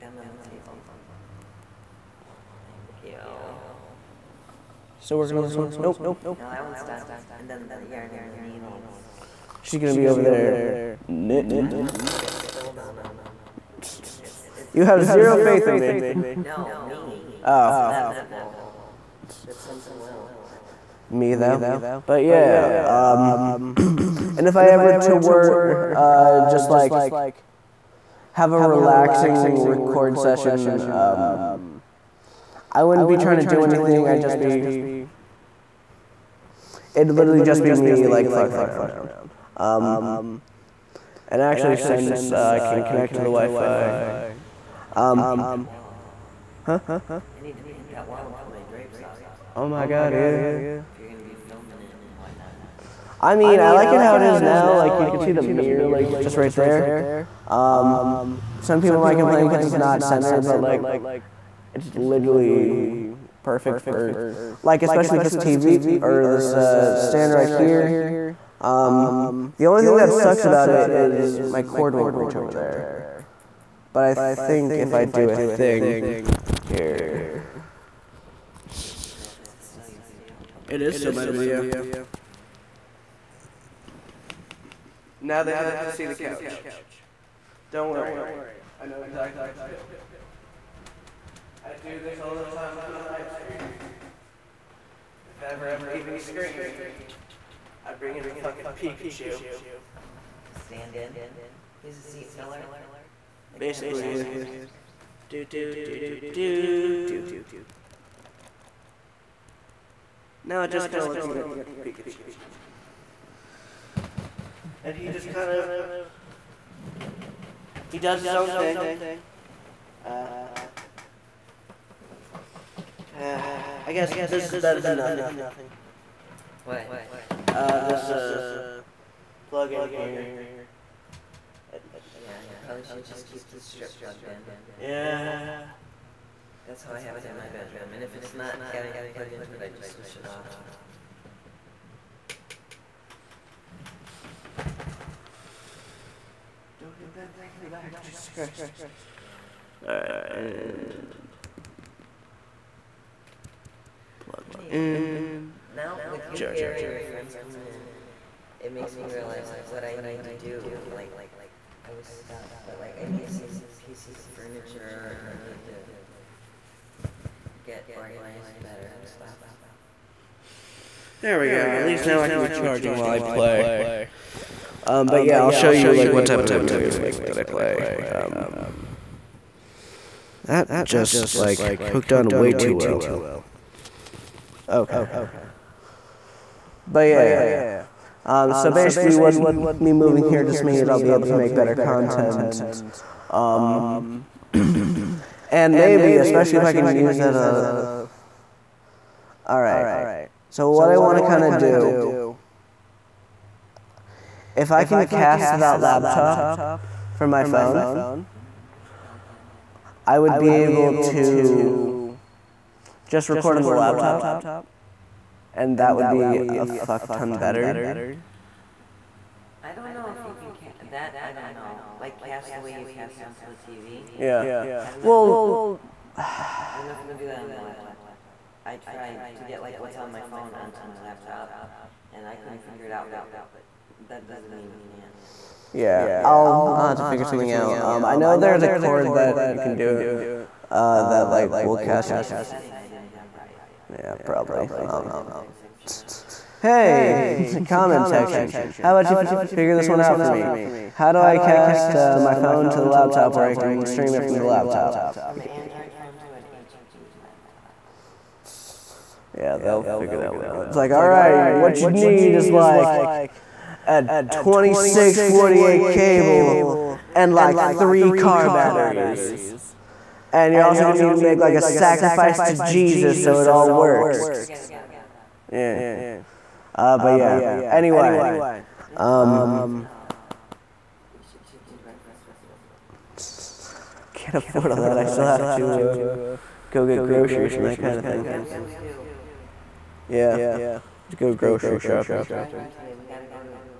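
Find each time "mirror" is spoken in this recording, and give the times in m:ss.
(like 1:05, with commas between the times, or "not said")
0:55.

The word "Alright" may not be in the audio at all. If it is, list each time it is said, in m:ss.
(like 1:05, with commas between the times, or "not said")
2:29, 3:19.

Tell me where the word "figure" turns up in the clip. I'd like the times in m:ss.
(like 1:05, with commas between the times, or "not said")
3:52, 3:57, 4:09, 4:19.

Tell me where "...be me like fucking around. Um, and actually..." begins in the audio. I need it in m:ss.
0:37.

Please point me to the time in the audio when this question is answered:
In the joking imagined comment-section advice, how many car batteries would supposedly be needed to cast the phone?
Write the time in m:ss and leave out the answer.
4:27.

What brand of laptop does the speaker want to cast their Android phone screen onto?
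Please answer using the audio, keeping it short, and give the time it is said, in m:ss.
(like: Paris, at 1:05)
HP, at 4:16.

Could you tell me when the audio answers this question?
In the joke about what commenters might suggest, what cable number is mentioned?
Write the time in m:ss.
4:24.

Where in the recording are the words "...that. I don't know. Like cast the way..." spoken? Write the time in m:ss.
3:40.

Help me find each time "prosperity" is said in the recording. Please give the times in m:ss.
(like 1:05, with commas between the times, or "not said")
not said.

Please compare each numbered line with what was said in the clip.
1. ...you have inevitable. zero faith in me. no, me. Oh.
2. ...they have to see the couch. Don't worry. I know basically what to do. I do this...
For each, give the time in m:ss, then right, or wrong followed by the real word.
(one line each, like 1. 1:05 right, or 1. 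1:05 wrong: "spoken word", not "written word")
1. 0:14 right
2. 1:25 wrong: "exactly", not "basically".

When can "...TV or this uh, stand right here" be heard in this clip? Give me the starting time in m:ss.
1:05.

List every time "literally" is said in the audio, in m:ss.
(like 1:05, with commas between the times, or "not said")
0:37, 1:01.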